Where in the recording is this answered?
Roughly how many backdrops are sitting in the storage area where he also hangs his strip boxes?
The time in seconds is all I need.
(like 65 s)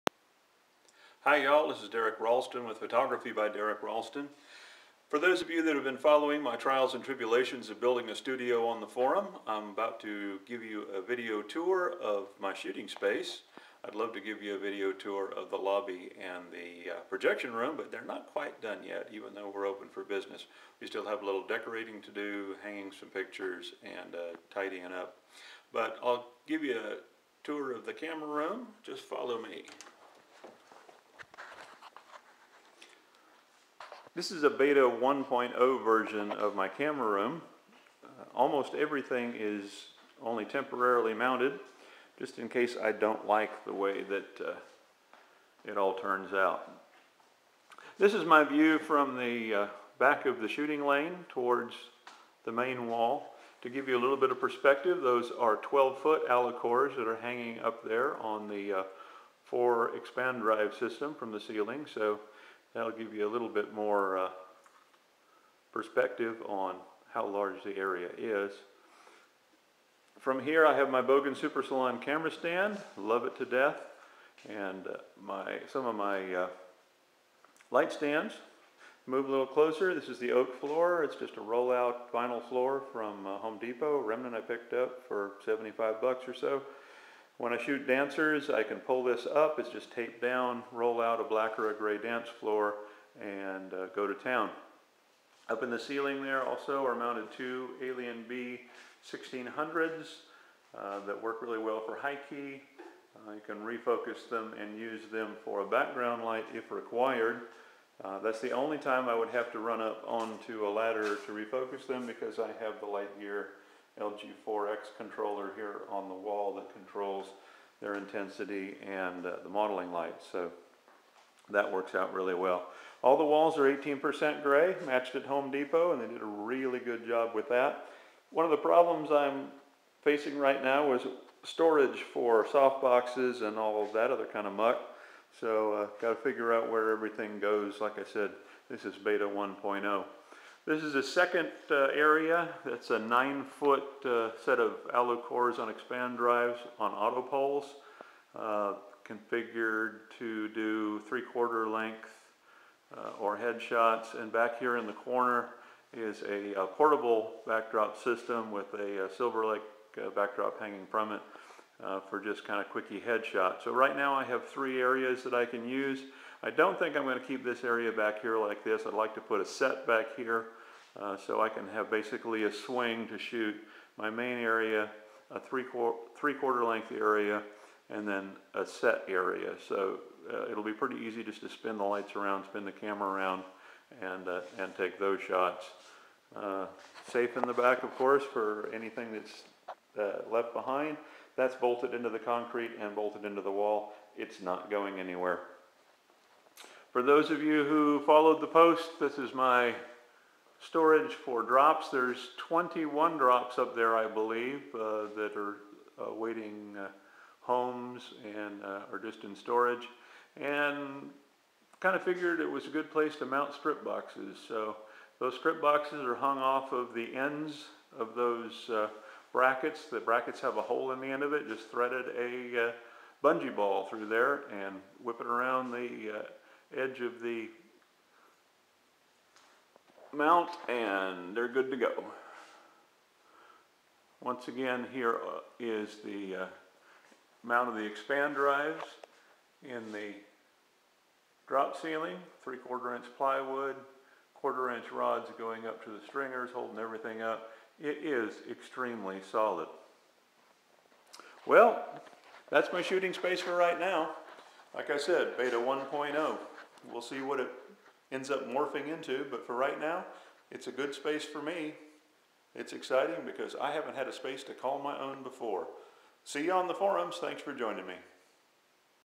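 202 s.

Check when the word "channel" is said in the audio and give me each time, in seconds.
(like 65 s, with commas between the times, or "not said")
not said.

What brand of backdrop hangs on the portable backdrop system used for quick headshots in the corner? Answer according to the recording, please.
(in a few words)
Silver Lake.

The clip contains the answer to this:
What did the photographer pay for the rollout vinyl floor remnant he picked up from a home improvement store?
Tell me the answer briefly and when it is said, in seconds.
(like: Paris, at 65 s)
$75, at 85 s.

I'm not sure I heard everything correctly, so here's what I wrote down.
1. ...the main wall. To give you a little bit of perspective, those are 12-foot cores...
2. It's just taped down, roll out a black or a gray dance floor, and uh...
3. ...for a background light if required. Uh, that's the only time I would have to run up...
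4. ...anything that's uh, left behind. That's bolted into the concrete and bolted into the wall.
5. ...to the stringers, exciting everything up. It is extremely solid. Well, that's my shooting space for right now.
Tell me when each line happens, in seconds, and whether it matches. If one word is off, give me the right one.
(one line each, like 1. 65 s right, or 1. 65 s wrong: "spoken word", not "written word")
1. 52 s wrong: "alacores", not "cores"
2. 89 s right
3. 105 s right
4. 188 s right
5. 245 s wrong: "holding", not "exciting".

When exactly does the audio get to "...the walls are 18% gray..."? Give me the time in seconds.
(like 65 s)
123 s.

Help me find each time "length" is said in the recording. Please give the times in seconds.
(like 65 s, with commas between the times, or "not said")
151 s, 176 s.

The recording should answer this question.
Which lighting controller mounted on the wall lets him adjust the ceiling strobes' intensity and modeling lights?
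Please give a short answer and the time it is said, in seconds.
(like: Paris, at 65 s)
LG4X, at 114 s.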